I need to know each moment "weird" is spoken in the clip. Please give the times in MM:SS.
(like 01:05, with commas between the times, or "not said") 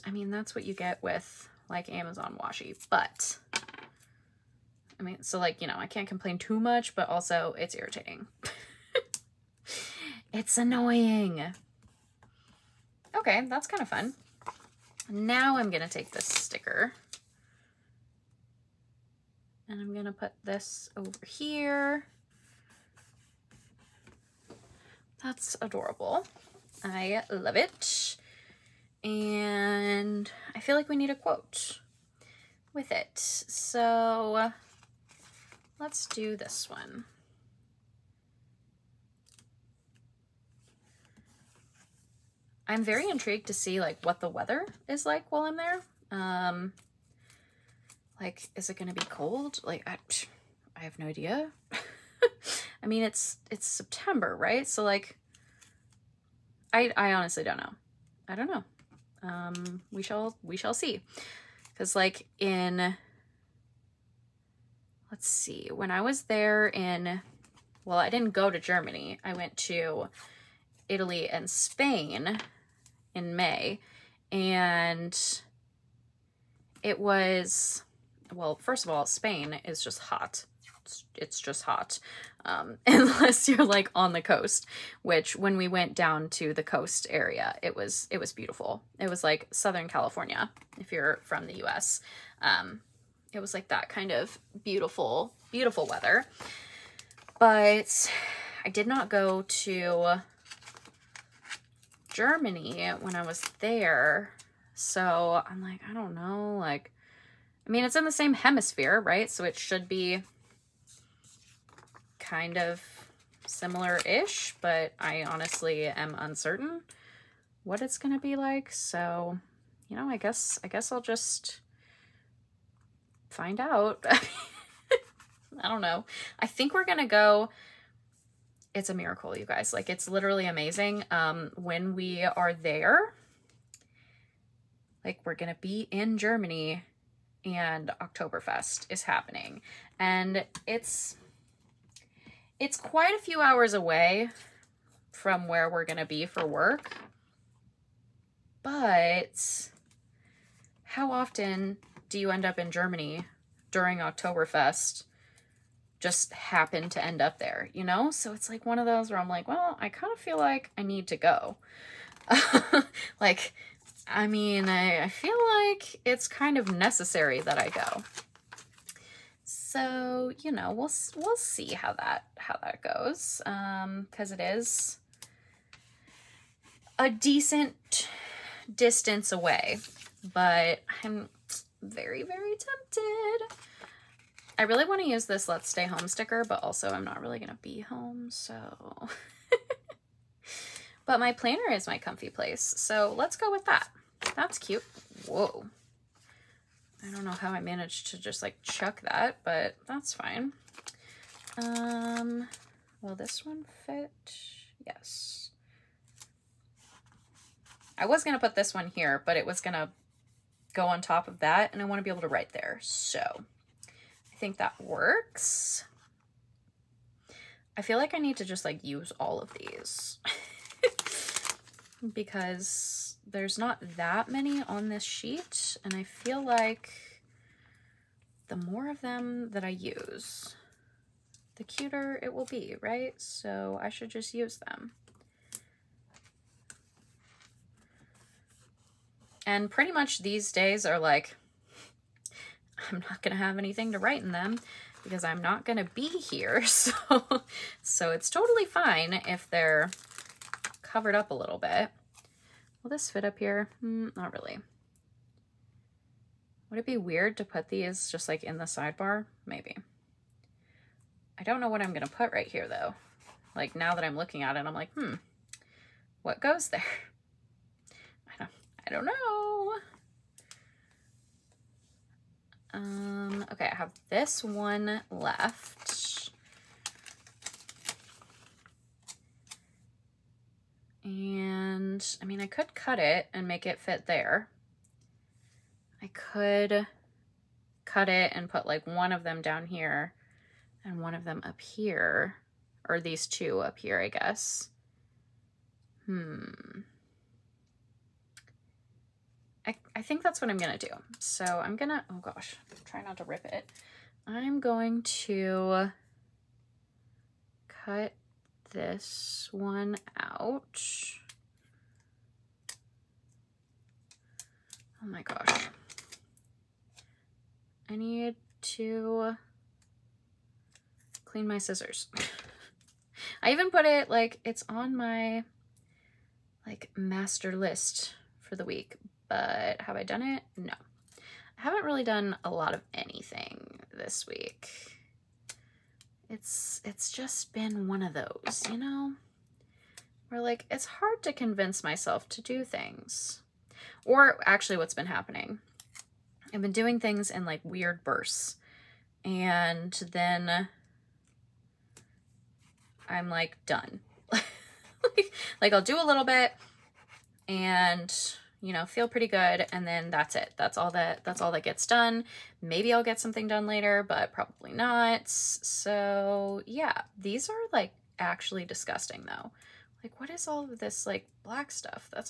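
04:16, 05:47.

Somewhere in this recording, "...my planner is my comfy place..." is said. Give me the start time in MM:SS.
03:11.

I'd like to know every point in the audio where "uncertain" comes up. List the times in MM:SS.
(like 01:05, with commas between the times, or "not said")
01:56.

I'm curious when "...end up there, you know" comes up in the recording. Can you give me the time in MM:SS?
02:37.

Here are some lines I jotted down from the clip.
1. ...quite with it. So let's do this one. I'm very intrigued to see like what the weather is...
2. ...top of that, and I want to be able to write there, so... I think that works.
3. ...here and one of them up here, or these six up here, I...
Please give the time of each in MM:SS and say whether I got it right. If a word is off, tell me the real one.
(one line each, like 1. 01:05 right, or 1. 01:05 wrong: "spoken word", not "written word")
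1. 00:31 wrong: "quote", not "quite"
2. 03:31 right
3. 04:49 wrong: "two", not "six".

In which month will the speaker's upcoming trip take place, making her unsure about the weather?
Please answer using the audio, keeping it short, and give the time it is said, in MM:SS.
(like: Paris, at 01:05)
September, at 00:53.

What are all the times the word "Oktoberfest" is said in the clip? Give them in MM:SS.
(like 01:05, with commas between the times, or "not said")
02:18, 02:33.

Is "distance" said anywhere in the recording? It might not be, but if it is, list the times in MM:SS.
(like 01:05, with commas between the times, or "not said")
02:58.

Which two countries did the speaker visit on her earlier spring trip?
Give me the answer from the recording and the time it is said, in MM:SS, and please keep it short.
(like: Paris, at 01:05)
Italy and Spain, at 01:10.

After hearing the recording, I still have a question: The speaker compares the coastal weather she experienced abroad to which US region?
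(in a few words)
Southern California.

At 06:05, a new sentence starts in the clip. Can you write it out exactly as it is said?
So yeah, these are like actually disgusting though.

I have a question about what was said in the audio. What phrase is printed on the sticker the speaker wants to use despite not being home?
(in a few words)
Let's Stay Home.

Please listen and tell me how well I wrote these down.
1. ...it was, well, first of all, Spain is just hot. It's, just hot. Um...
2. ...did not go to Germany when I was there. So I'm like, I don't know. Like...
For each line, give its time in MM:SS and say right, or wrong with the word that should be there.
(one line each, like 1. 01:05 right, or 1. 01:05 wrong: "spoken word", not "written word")
1. 01:16 right
2. 01:38 right.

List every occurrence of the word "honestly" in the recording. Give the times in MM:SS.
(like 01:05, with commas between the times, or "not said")
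00:57, 01:55.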